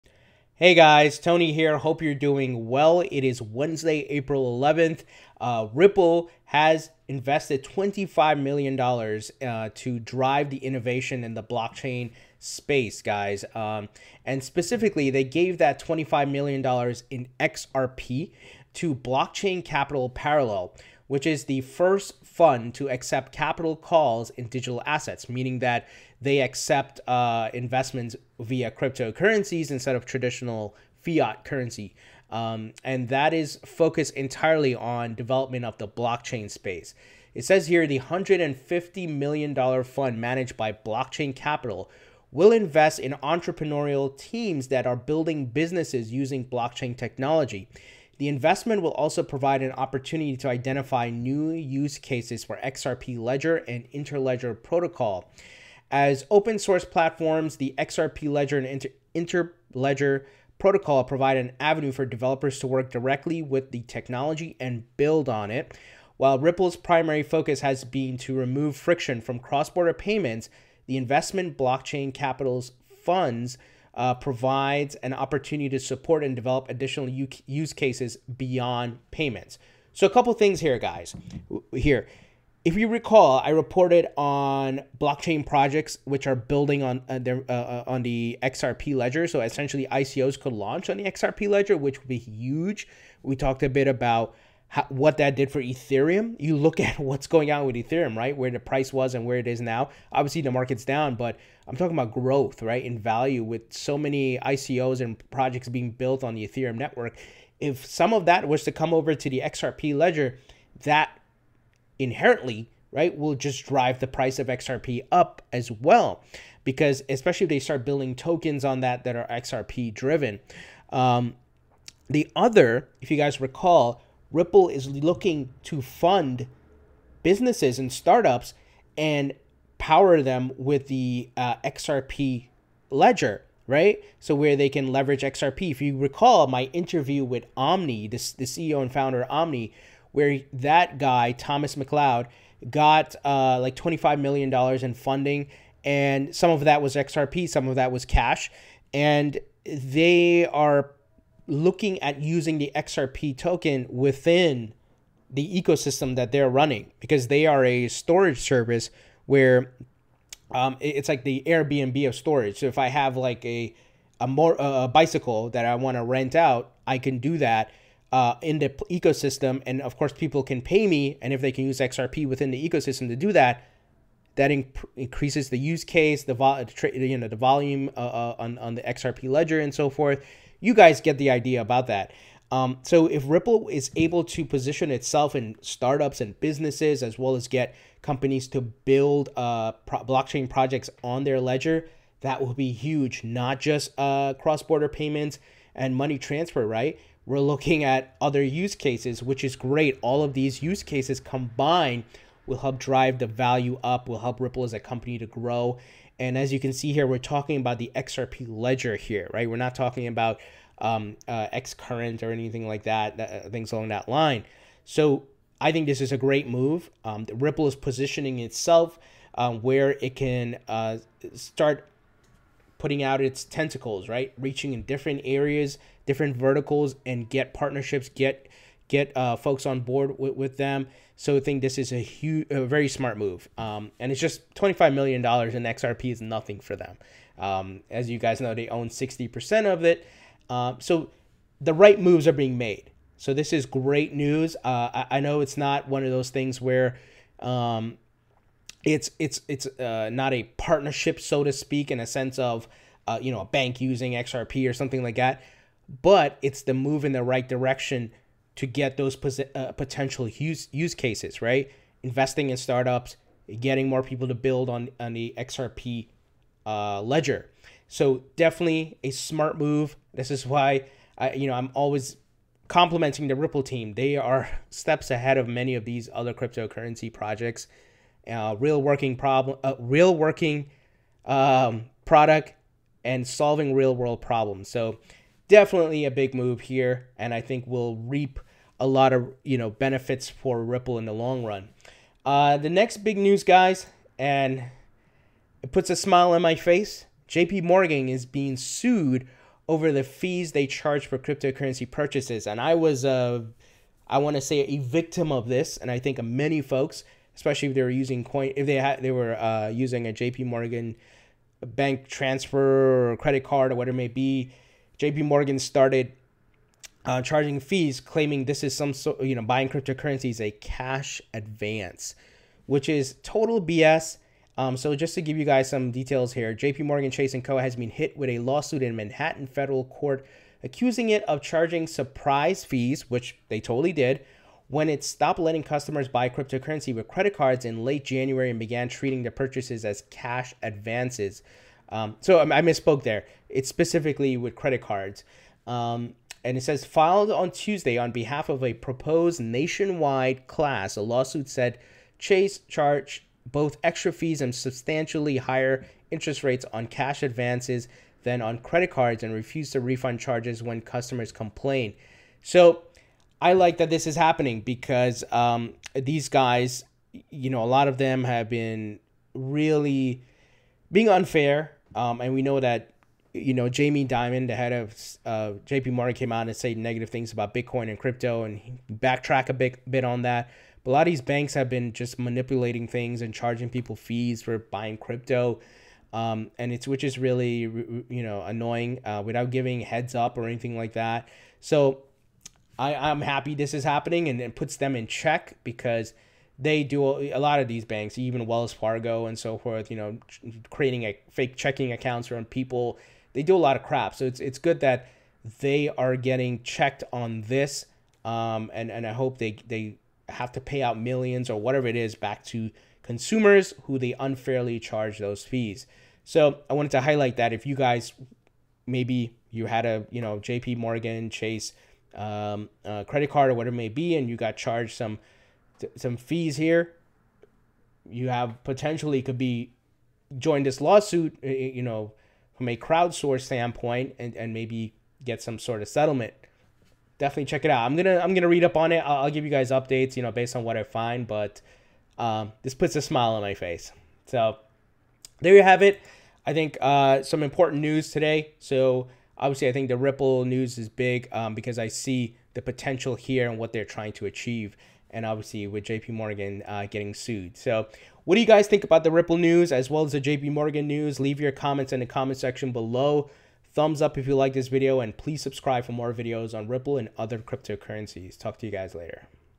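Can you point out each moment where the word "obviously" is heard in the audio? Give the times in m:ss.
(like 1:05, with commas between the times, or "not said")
1:40, 7:29, 7:35.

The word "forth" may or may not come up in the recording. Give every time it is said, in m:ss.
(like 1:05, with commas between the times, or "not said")
2:59, 6:39.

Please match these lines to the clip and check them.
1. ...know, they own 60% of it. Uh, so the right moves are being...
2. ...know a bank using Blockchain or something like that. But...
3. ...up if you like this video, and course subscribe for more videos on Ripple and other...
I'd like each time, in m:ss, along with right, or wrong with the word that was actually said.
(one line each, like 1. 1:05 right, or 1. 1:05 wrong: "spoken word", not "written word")
1. 3:58 right
2. 4:13 wrong: "XRP", not "Blockchain"
3. 7:44 wrong: "please", not "course".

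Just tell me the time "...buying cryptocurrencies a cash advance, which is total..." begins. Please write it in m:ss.
5:19.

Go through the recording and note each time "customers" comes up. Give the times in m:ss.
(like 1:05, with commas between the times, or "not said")
5:35, 6:00.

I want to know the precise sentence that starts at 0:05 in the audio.
Uh, Ripple has invested $25 million uh, to drive the innovation in the blockchain space, guys.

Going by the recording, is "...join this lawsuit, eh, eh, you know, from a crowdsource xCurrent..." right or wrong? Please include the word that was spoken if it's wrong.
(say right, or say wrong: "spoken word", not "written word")
wrong: "standpoint", not "xCurrent".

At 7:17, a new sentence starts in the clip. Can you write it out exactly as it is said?
I'm gonna I'm gonna read up on it.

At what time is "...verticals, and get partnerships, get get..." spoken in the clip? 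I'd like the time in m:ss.
3:46.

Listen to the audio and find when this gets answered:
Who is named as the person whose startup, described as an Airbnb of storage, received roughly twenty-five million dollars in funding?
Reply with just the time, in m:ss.
2:21.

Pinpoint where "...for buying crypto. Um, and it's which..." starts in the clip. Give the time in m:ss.
6:24.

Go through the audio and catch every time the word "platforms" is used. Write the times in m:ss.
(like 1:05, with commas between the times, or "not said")
0:56.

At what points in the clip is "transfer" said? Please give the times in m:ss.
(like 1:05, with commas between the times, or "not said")
3:16, 5:12.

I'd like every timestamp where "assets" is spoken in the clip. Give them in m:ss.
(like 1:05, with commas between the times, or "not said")
0:24.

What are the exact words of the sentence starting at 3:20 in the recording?
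All of these use cases combined will help drive the value up, will help Ripple as a company to grow.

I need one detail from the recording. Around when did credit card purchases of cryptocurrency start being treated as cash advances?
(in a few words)
late January.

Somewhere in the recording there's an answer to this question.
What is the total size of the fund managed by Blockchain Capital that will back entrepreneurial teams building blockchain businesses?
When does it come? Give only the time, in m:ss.
0:37.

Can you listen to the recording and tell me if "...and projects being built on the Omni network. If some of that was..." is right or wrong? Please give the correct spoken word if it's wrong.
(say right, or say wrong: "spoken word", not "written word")
wrong: "Ethereum", not "Omni".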